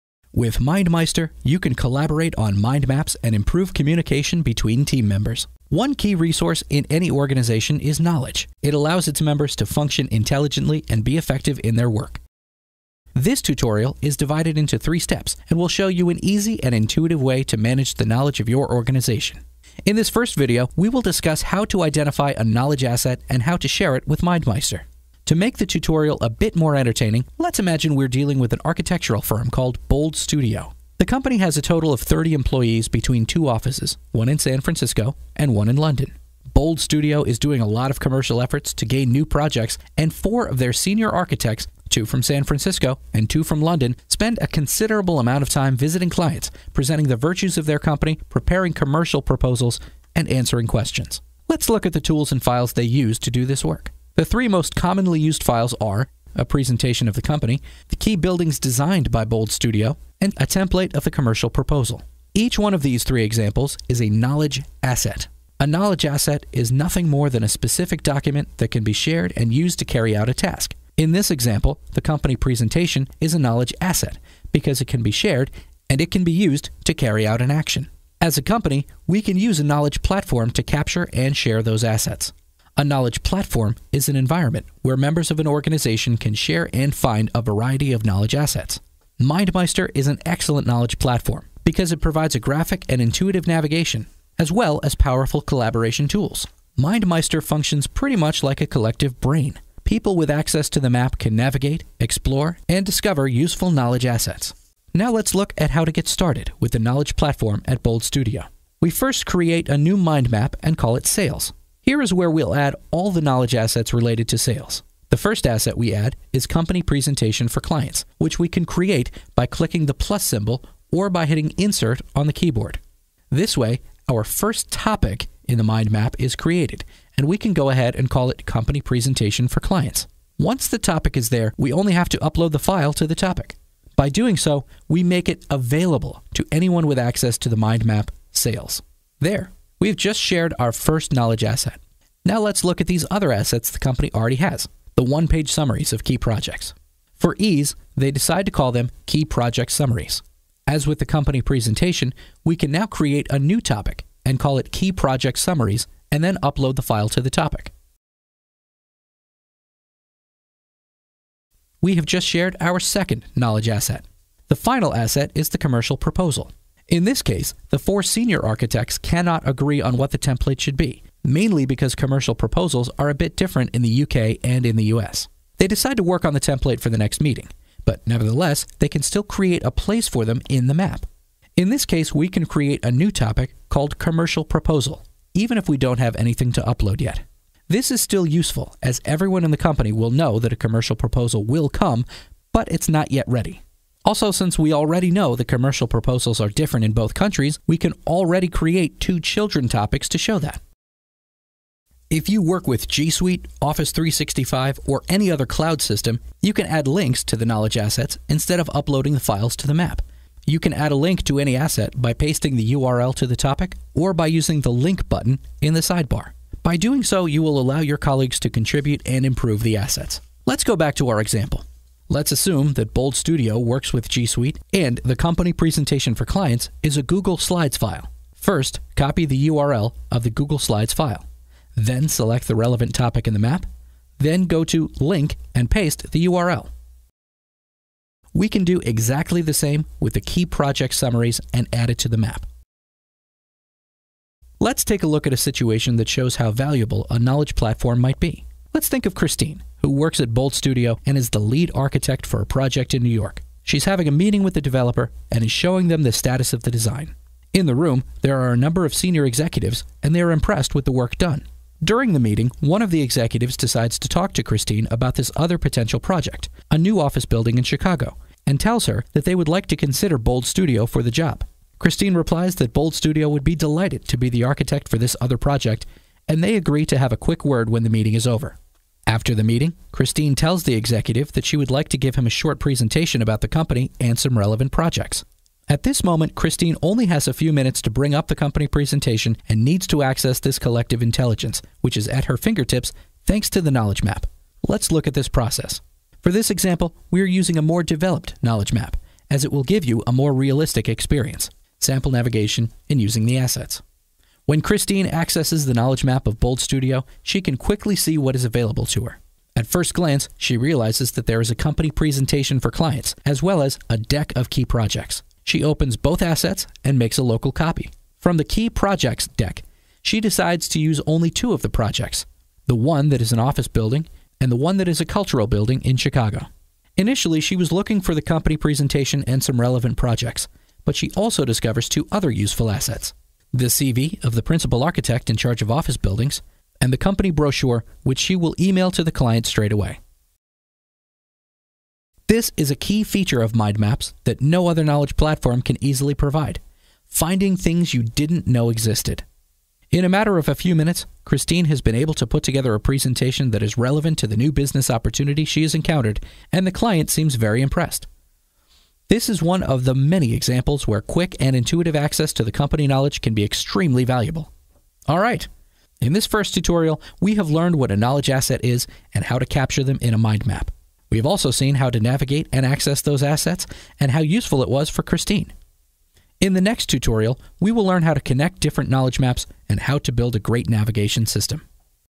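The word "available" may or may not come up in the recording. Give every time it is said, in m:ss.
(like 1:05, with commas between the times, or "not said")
2:15, 5:08.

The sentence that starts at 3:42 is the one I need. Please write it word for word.
Let's assume that Bold Studio works with G Suite and the company presentation for clients is a Google Slides file.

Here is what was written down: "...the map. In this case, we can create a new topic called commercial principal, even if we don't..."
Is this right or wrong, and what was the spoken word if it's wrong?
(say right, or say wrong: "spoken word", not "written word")
wrong: "proposal", not "principal".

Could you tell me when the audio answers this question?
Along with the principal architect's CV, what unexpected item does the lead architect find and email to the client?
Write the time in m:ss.
5:36.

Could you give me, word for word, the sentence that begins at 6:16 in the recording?
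In the next tutorial, we will learn how to connect different knowledge maps and how to build a great navigation system.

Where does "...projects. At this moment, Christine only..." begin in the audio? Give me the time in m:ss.
4:44.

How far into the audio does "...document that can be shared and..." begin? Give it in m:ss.
1:08.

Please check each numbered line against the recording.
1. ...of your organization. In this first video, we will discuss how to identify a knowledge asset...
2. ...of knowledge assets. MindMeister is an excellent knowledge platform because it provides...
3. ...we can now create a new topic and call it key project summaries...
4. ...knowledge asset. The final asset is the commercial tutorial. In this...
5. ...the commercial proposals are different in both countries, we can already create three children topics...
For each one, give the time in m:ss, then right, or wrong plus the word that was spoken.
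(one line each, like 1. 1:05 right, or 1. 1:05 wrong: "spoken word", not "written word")
1. 0:18 right
2. 1:27 right
3. 2:32 right
4. 2:43 wrong: "proposal", not "tutorial"
5. 3:15 wrong: "two", not "three".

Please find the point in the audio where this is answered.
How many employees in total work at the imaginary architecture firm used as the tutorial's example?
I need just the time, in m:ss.
0:32.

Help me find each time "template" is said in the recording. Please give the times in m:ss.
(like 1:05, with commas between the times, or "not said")
1:00, 2:50, 2:56.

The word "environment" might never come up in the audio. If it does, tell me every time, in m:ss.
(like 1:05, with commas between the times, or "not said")
1:24.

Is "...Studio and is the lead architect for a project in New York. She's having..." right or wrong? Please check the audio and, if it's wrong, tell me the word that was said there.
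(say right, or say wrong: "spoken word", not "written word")
right.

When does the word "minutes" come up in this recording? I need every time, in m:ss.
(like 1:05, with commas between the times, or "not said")
4:47, 5:50.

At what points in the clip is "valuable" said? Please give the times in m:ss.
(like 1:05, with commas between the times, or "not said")
4:06, 6:04.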